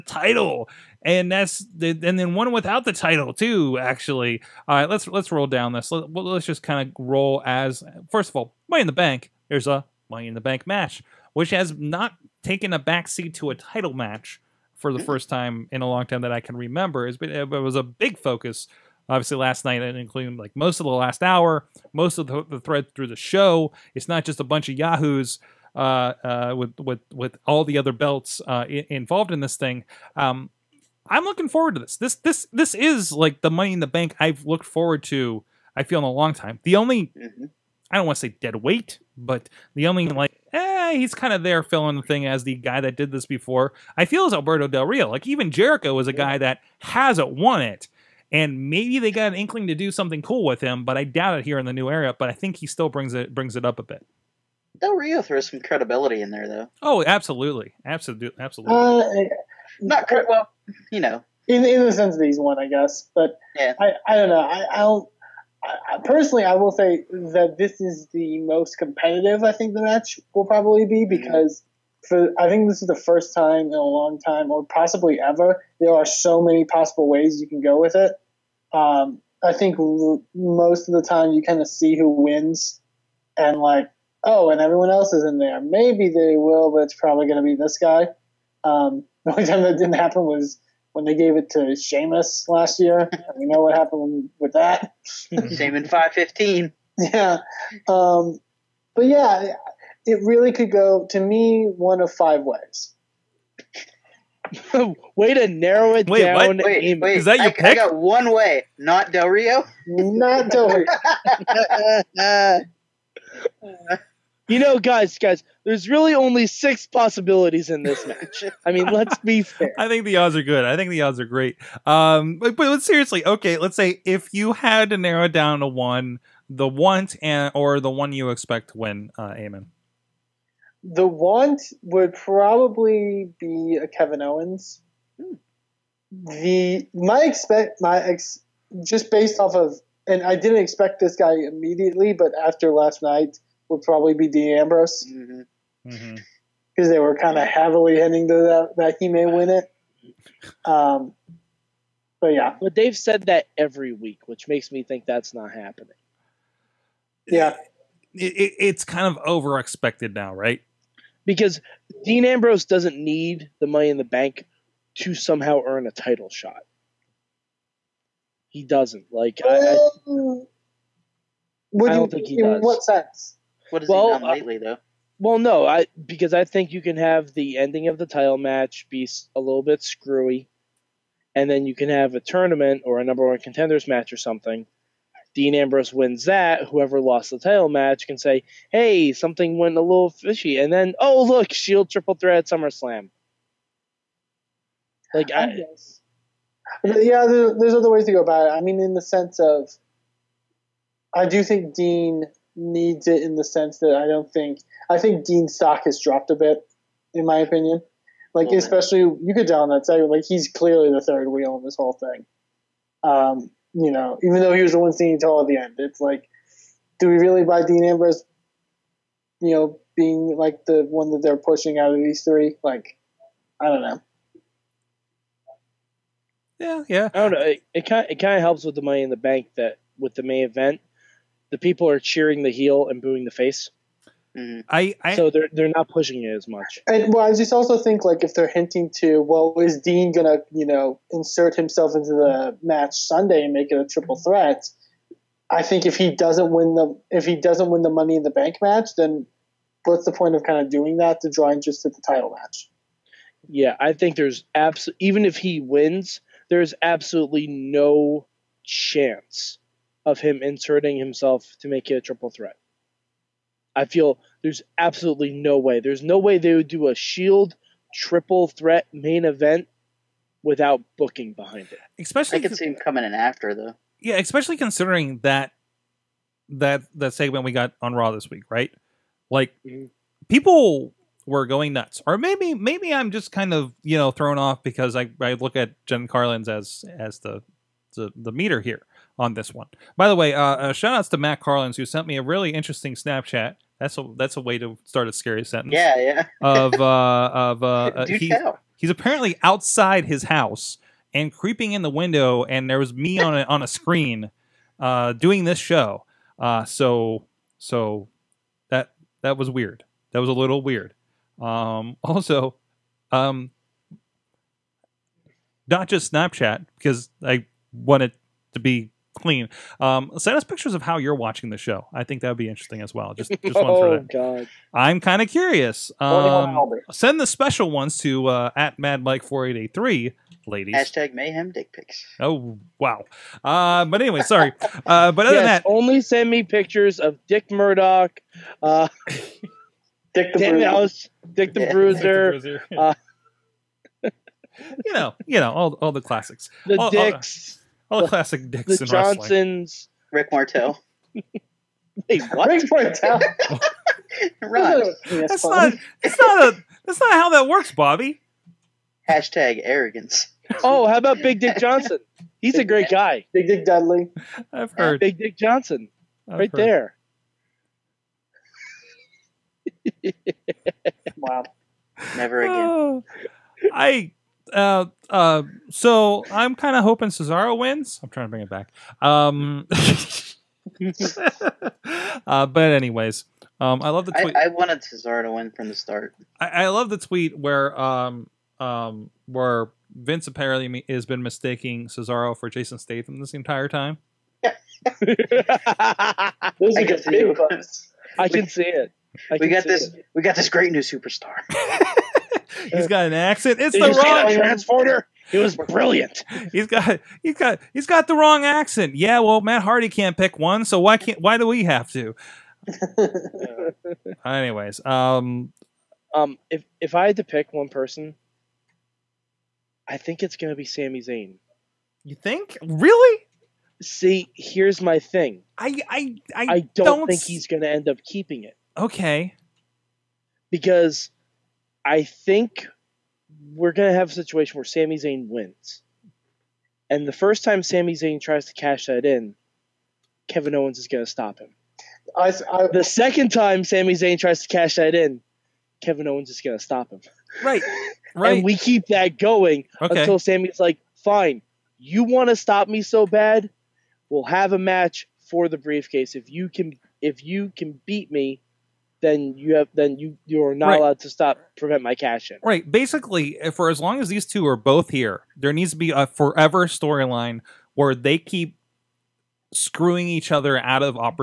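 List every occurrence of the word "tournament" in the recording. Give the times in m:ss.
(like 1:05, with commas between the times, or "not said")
3:02.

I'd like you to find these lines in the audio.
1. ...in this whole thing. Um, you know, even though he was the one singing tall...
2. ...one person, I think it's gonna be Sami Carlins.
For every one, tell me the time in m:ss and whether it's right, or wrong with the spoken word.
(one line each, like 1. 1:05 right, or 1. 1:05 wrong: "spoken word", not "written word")
1. 3:31 right
2. 6:57 wrong: "Zayn", not "Carlins".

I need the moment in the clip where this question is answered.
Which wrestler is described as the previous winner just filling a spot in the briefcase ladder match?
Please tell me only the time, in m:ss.
0:44.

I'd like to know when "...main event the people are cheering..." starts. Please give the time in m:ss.
3:50.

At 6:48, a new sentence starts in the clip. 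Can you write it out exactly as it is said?
Yeah, well, Matt Hardy can't pick one, so why can't why do we have to?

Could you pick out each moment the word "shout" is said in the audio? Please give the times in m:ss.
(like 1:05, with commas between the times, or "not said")
4:50.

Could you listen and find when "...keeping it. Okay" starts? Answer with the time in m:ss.
7:08.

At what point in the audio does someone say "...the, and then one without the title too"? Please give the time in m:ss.
0:01.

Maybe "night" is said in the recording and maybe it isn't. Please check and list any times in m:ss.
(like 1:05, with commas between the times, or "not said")
0:19, 2:23.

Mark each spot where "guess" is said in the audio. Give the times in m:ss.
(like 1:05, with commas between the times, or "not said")
1:02, 3:15.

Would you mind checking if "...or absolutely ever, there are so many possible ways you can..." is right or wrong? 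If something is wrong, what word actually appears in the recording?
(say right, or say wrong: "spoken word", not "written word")
wrong: "possibly", not "absolutely".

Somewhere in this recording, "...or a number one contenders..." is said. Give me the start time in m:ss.
3:02.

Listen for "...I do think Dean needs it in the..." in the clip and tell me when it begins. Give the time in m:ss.
3:21.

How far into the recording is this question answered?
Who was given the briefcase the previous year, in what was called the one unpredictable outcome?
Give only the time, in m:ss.
1:31.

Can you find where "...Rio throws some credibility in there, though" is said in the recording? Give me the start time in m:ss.
0:54.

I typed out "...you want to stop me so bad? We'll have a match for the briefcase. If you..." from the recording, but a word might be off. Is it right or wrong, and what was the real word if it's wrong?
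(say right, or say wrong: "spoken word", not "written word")
right.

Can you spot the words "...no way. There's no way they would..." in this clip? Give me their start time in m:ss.
4:25.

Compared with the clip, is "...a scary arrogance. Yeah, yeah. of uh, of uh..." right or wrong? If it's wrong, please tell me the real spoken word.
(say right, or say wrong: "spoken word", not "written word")
wrong: "sentence", not "arrogance".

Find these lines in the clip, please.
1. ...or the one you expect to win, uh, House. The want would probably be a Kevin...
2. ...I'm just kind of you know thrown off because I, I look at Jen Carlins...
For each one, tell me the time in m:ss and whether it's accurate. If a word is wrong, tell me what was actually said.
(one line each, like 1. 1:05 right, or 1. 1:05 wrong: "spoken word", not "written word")
1. 2:07 wrong: "Amen", not "House"
2. 4:42 right.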